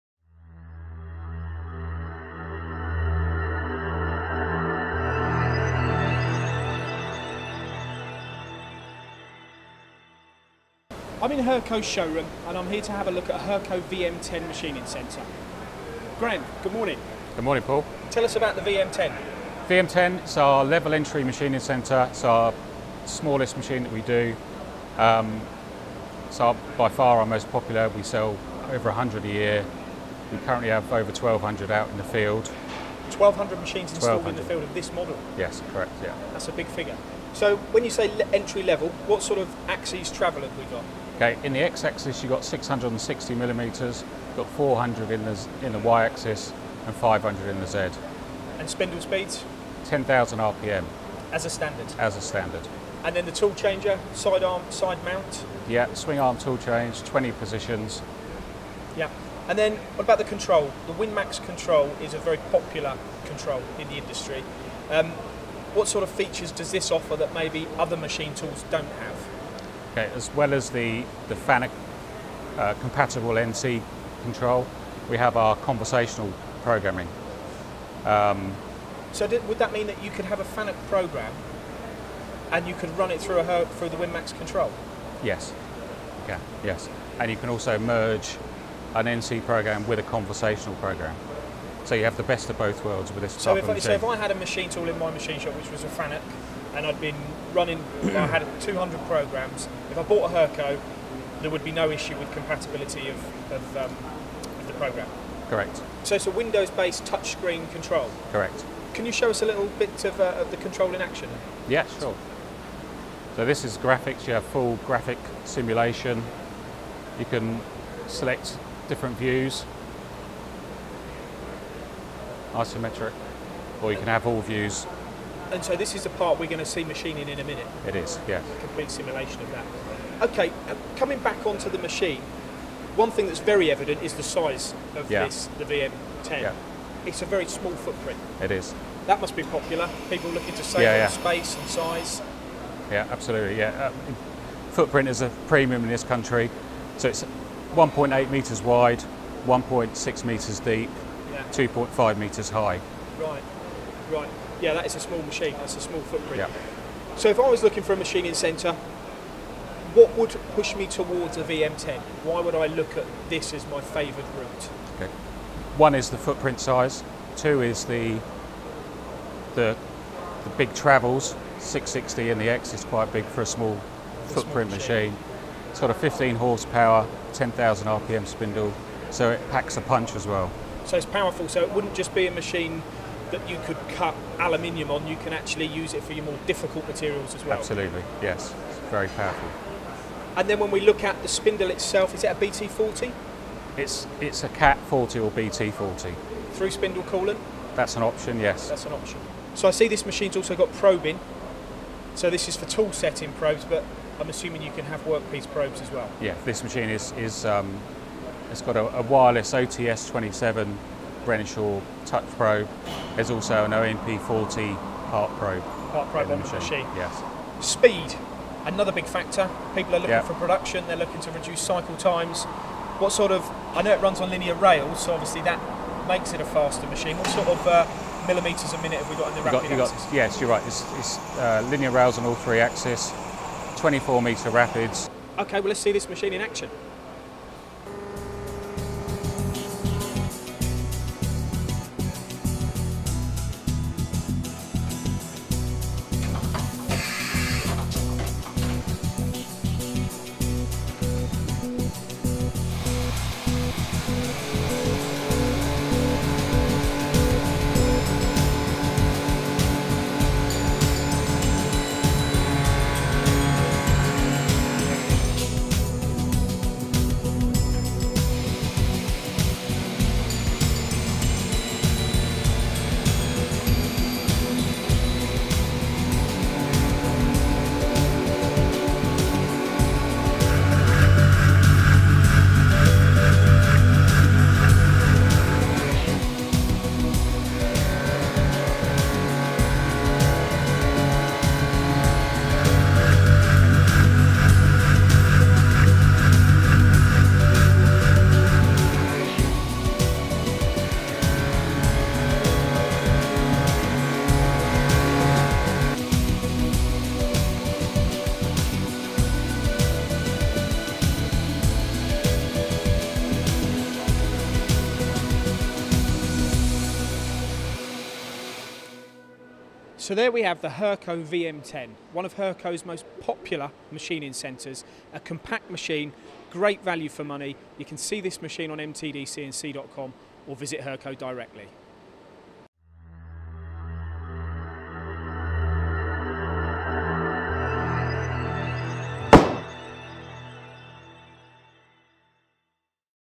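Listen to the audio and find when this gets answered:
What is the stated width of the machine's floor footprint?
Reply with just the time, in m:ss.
2:27.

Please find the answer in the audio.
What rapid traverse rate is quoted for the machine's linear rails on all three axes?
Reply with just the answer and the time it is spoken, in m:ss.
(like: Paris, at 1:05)
24 metres per minute, at 3:53.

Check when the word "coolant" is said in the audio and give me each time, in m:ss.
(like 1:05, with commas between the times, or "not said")
3:17.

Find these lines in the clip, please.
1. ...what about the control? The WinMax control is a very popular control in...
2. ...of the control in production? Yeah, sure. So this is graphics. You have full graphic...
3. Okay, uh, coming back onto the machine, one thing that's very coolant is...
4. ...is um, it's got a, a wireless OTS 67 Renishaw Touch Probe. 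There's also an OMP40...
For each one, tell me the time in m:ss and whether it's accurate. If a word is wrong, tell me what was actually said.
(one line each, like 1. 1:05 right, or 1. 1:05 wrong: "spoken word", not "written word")
1. 0:59 right
2. 1:50 wrong: "action", not "production"
3. 2:10 wrong: "evident", not "coolant"
4. 3:27 wrong: "27", not "67".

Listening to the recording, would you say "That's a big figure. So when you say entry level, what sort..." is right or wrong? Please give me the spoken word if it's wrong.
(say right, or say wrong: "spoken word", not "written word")
right.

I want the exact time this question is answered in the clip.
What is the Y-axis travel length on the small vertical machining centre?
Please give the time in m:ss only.
0:44.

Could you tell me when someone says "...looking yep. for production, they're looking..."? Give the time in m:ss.
3:39.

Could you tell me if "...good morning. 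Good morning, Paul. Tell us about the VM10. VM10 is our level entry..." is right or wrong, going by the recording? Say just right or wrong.
right.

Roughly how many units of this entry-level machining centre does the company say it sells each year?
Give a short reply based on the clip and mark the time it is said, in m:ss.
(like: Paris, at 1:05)
over 100, at 0:28.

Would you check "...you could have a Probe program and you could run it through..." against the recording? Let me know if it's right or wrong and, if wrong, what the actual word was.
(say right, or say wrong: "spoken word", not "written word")
wrong: "FANUC", not "Probe".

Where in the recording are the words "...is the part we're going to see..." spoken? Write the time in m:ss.
2:05.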